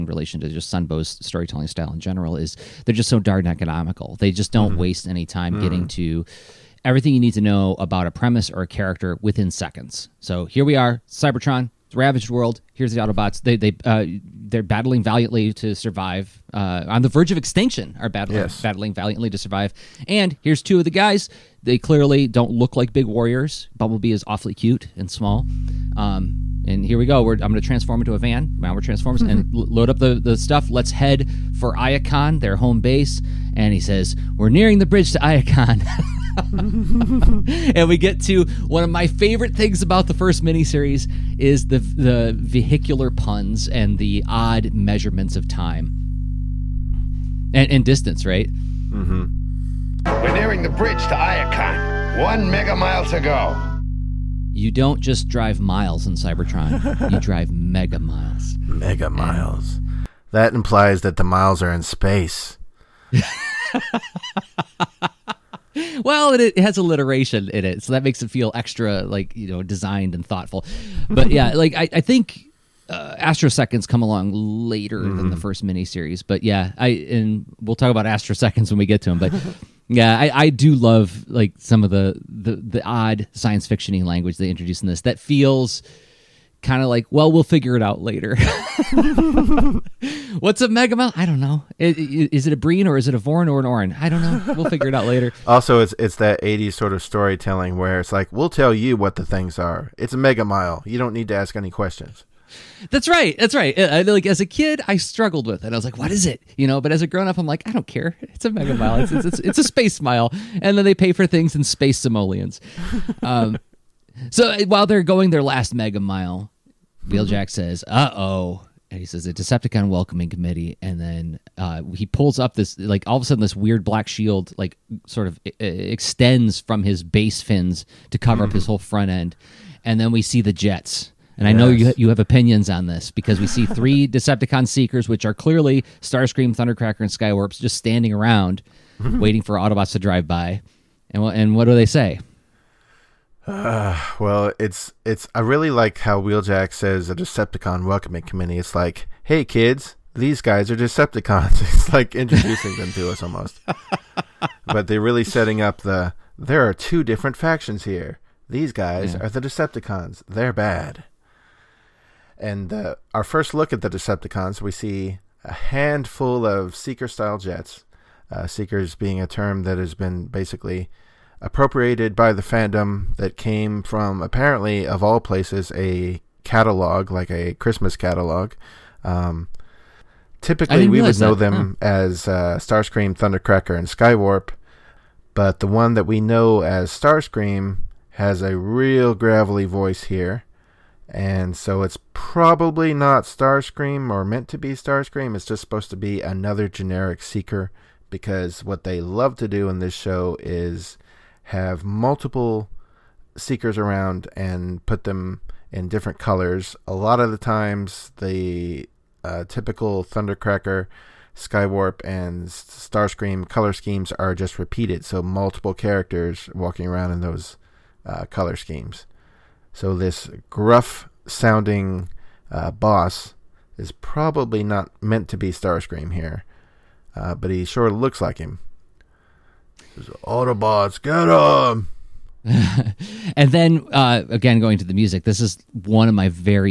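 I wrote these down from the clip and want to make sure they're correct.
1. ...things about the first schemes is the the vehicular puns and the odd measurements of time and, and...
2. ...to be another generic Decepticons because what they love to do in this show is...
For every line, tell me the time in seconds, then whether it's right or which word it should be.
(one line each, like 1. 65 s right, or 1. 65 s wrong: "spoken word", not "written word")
1. 39 s wrong: "miniseries", not "schemes"
2. 195 s wrong: "Seeker", not "Decepticons".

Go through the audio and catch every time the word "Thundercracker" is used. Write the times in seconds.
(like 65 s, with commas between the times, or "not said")
136 s, 183 s, 210 s.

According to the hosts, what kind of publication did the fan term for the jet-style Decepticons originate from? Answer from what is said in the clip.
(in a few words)
A Christmas catalog.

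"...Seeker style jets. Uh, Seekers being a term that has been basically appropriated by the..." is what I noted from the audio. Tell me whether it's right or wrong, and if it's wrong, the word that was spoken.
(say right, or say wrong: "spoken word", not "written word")
right.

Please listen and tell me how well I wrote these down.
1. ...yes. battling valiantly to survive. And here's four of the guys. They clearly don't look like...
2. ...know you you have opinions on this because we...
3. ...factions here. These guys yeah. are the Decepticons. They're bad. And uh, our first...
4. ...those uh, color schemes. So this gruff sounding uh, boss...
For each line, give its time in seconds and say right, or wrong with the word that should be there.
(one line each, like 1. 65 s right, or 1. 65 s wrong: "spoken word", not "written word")
1. 18 s wrong: "two", not "four"
2. 131 s right
3. 157 s right
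4. 217 s right.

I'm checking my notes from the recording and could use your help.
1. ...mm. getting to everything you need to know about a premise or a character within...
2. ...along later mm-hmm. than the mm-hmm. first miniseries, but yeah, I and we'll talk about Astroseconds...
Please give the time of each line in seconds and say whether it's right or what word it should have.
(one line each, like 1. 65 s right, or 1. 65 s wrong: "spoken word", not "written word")
1. 5 s right
2. 74 s right.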